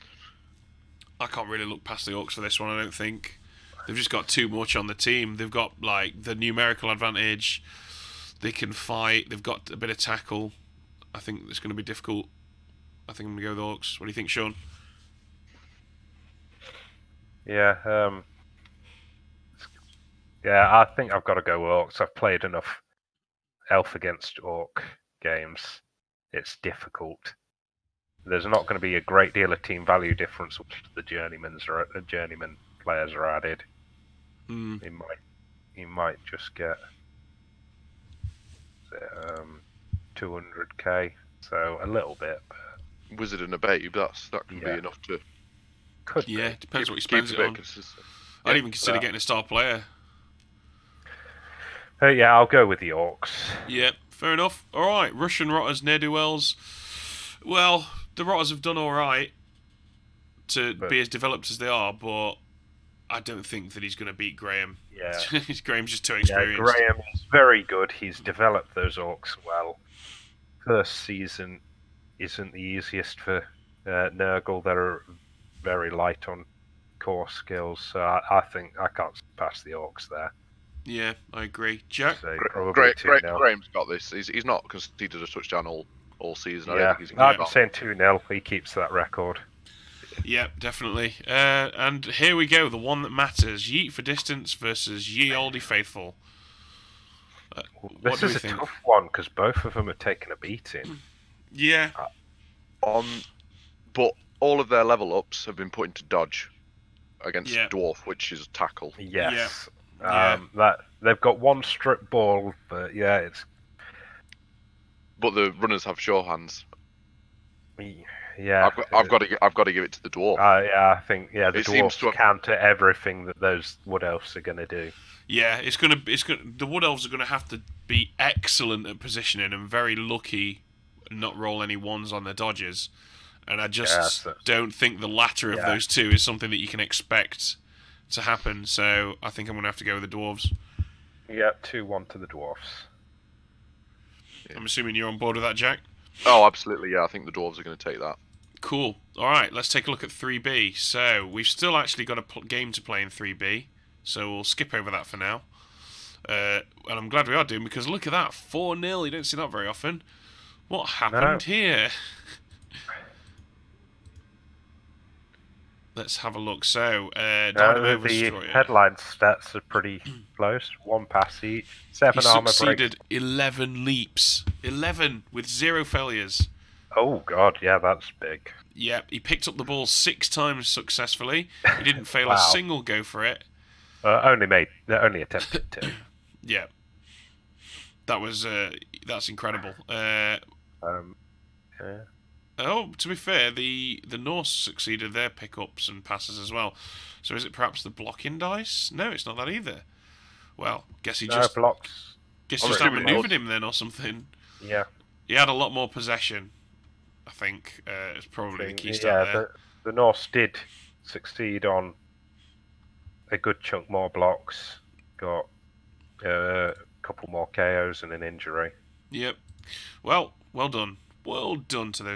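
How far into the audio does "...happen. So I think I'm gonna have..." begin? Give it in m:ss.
2:18.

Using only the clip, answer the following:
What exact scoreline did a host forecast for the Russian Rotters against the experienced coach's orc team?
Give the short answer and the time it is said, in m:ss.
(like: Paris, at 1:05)
2-0, at 1:27.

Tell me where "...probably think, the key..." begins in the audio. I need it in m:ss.
3:28.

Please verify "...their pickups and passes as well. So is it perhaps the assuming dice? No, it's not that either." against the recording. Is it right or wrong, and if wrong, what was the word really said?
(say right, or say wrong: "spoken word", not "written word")
wrong: "blocking", not "assuming".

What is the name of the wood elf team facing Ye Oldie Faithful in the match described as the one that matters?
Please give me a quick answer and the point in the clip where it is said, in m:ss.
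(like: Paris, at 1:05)
Yeet for distance, at 1:33.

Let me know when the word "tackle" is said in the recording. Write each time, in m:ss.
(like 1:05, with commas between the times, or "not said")
0:09, 1:48.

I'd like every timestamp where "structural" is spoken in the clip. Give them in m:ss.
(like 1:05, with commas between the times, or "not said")
not said.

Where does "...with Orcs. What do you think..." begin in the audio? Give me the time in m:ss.
0:13.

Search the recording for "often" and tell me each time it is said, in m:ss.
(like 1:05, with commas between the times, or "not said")
2:39.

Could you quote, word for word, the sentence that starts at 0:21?
I've played enough Elf against Orc games.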